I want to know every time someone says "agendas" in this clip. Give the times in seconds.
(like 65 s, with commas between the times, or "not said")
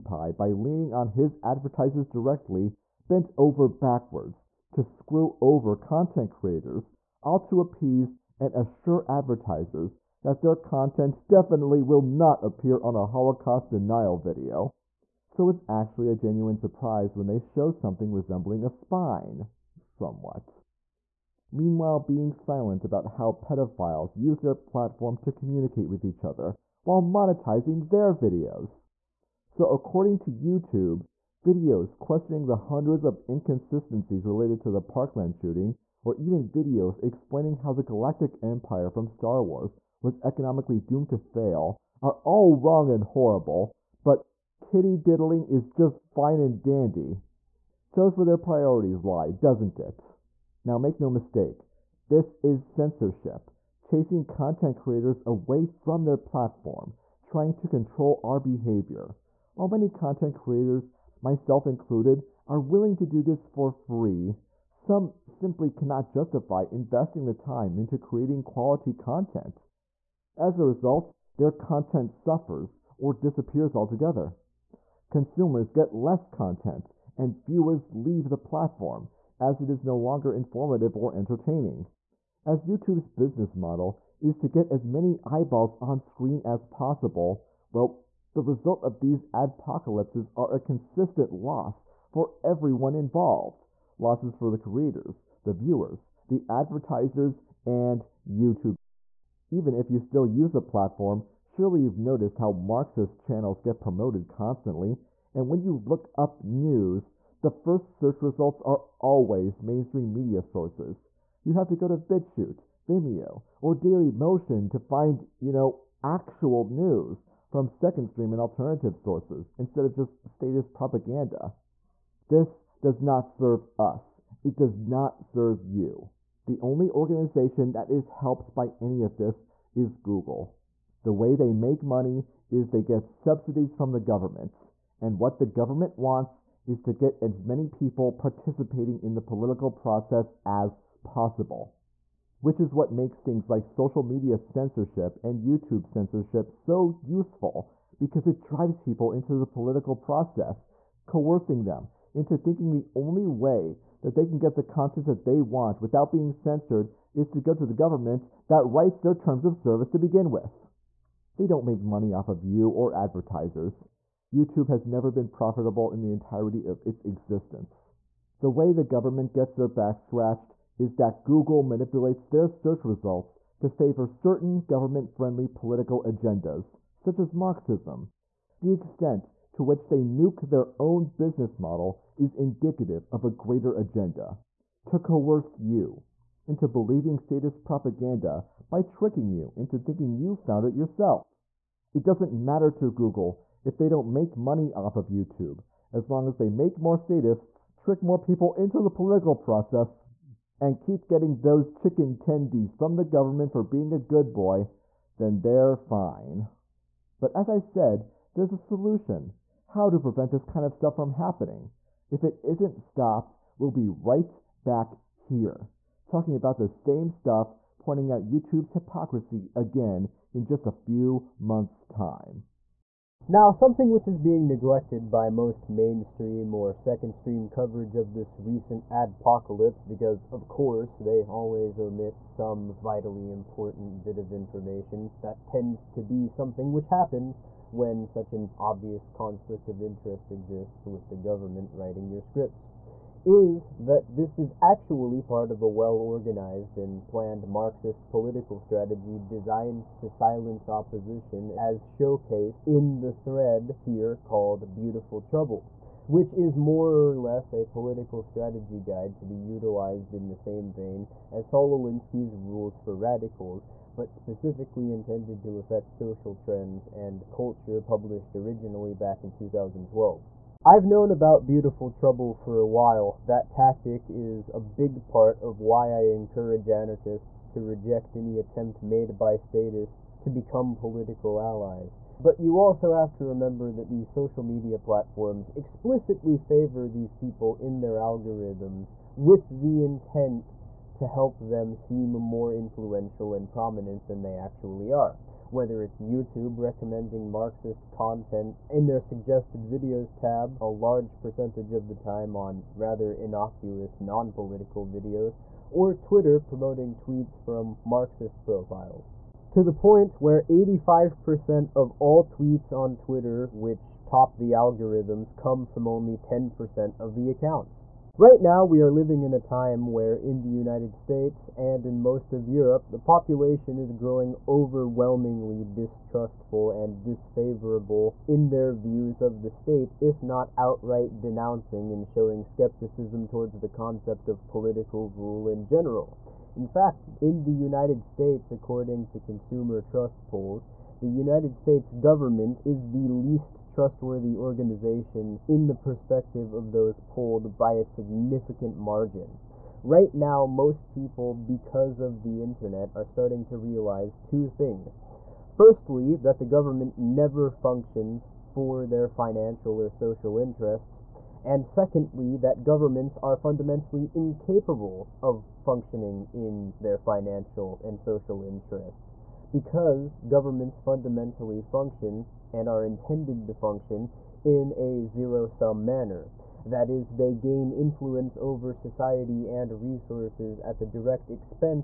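176 s, 183 s.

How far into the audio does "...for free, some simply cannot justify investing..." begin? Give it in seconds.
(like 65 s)
63 s.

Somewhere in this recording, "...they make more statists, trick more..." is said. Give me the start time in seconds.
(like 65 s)
196 s.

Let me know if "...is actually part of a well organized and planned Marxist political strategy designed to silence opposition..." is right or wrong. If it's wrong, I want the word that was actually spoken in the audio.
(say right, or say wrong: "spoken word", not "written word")
right.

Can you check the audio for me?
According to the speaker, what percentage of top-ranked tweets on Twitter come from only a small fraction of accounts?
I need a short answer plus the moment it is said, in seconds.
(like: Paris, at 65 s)
85%, at 310 s.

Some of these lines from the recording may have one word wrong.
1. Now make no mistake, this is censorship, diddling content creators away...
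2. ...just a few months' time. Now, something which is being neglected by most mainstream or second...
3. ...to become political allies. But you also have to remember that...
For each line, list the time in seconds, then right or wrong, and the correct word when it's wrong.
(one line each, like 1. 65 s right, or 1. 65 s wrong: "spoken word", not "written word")
1. 50 s wrong: "chasing", not "diddling"
2. 220 s right
3. 280 s right.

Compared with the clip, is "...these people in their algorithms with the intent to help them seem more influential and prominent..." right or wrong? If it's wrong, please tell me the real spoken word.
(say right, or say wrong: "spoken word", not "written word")
right.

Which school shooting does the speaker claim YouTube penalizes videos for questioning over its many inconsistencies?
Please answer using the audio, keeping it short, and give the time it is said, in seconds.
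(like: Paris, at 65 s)
Parkland, at 34 s.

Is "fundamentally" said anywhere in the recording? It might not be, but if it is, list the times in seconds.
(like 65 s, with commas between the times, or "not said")
363 s, 370 s.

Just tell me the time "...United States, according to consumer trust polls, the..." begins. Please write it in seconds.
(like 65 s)
337 s.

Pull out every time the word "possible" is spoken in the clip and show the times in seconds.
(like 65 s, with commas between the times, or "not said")
86 s, 141 s.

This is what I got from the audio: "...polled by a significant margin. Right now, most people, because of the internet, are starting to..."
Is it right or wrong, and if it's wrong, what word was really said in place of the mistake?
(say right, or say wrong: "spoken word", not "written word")
right.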